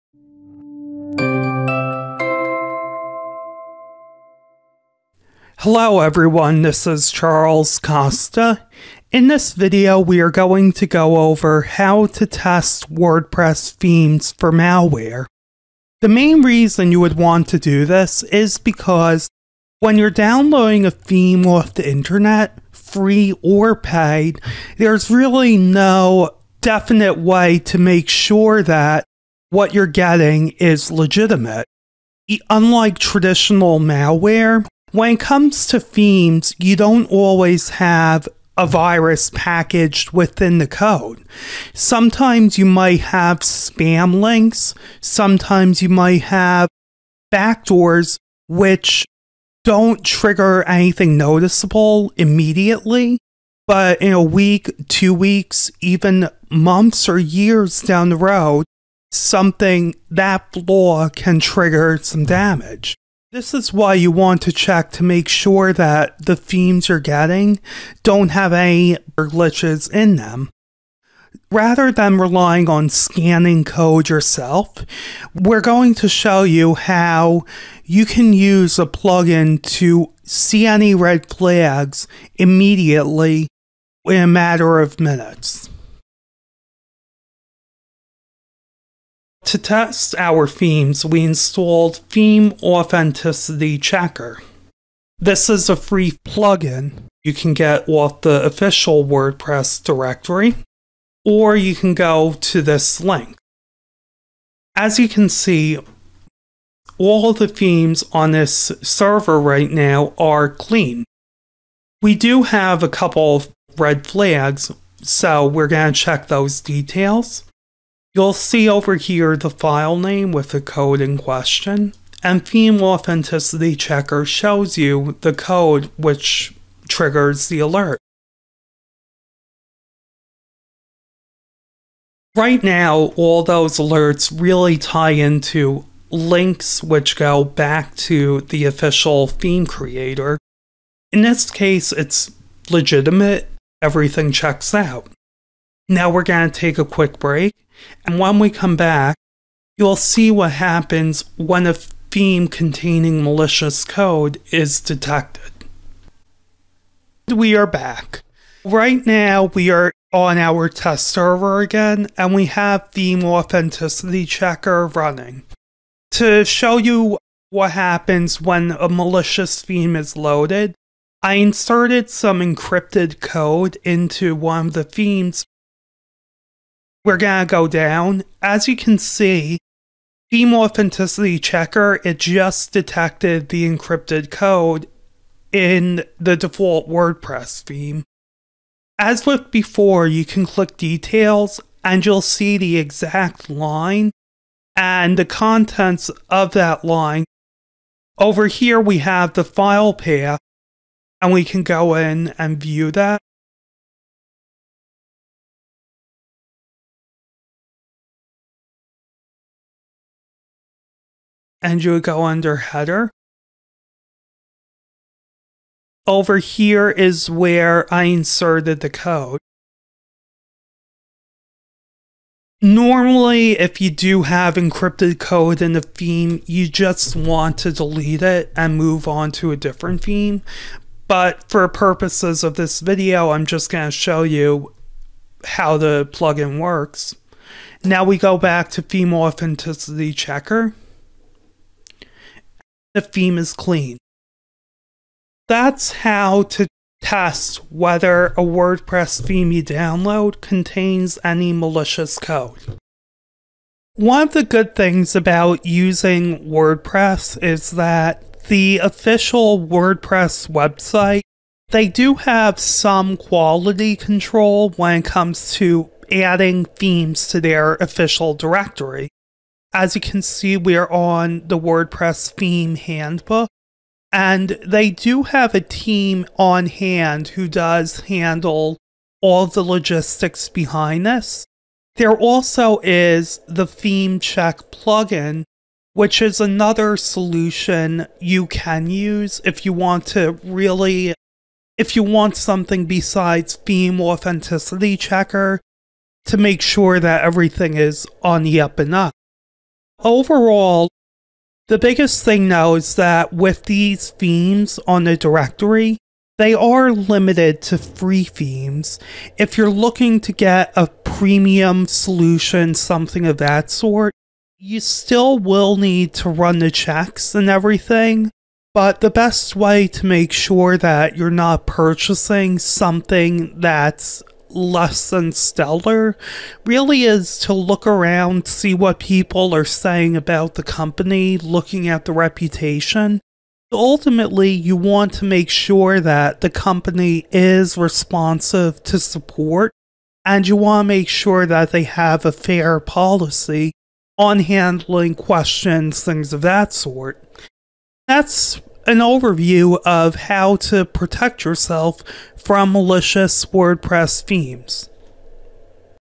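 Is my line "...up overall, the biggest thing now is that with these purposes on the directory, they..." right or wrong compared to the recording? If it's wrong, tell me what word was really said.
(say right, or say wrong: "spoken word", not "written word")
wrong: "themes", not "purposes".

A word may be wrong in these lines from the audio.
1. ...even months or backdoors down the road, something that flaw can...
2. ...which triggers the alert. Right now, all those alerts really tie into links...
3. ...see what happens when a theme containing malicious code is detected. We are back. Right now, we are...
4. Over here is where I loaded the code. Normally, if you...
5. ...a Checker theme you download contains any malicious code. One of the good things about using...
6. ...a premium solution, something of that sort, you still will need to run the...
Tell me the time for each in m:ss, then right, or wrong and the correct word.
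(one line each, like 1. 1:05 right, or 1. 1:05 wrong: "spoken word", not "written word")
1. 0:55 wrong: "years", not "backdoors"
2. 2:05 right
3. 2:29 right
4. 3:36 wrong: "inserted", not "loaded"
5. 4:08 wrong: "WordPress", not "Checker"
6. 5:10 right.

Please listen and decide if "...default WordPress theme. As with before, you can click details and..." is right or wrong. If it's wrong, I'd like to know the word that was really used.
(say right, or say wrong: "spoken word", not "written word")
right.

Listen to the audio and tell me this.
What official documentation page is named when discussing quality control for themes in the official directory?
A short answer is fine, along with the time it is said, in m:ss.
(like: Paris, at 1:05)
WordPress theme handbook, at 4:31.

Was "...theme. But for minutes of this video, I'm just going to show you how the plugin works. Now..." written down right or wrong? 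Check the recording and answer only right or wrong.
wrong.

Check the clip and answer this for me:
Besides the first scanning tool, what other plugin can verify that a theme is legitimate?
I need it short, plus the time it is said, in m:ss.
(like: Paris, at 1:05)
Theme check, at 4:43.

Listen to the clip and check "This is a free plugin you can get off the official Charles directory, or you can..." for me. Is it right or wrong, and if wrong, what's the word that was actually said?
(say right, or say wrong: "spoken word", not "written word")
wrong: "WordPress", not "Charles".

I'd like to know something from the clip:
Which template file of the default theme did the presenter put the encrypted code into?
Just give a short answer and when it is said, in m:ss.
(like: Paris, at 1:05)
header, at 3:32.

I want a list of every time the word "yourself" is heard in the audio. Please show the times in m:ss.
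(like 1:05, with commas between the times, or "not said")
1:14, 5:51.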